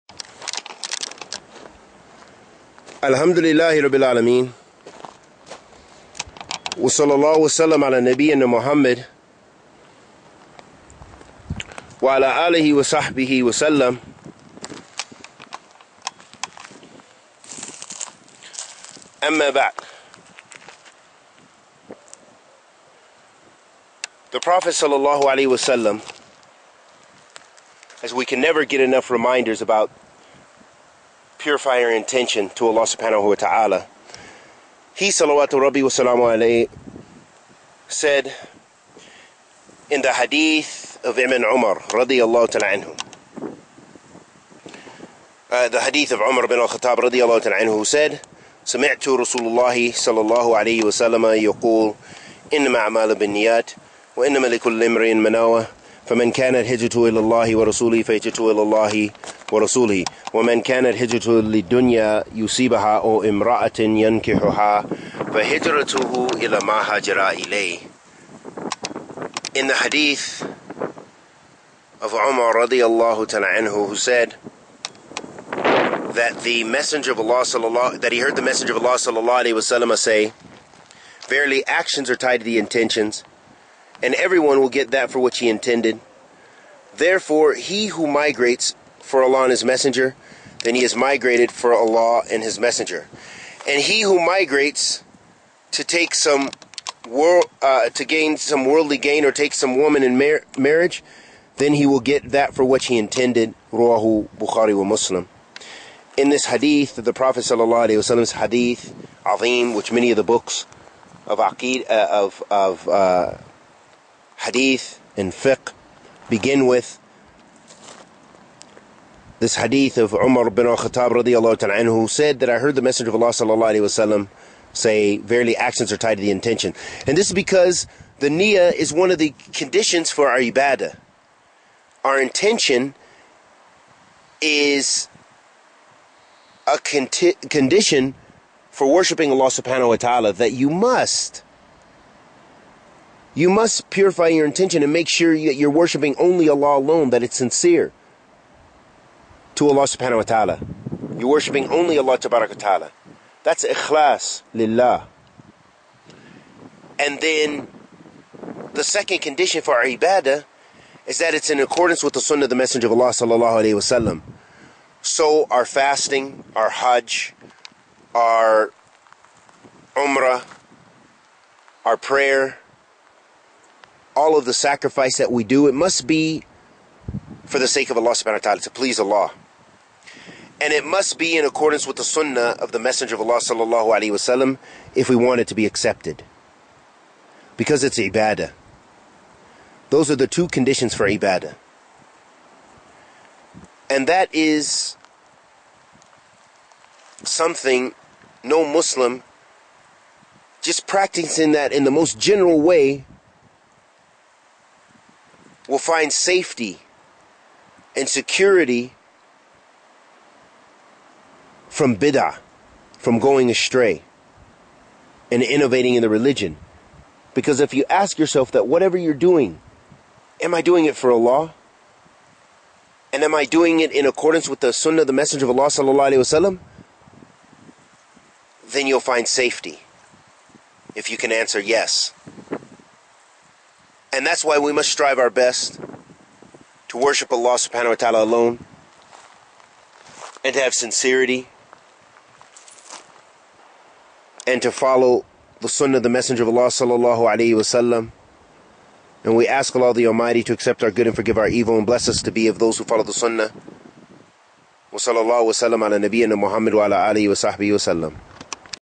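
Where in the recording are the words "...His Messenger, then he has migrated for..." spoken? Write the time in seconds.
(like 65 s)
89 s.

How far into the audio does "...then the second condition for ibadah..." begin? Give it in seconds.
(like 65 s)
157 s.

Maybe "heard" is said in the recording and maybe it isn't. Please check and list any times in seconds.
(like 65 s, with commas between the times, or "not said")
78 s, 122 s.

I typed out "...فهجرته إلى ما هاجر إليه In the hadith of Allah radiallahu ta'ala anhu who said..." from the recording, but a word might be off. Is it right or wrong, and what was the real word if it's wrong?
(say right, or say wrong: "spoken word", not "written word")
wrong: "Umar", not "Allah".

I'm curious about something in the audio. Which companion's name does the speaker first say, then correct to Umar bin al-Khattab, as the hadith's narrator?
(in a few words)
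Ibn Umar.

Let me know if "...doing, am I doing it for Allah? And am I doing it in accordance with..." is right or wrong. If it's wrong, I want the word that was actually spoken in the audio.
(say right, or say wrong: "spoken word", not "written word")
right.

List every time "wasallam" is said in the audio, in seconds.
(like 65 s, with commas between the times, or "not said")
25 s, 79 s, 107 s, 123 s, 163 s, 184 s, 247 s.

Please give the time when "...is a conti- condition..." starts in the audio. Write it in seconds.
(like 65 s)
134 s.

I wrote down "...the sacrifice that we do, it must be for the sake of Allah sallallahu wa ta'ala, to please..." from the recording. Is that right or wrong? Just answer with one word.
wrong.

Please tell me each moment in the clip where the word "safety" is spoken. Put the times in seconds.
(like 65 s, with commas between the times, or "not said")
206 s, 229 s.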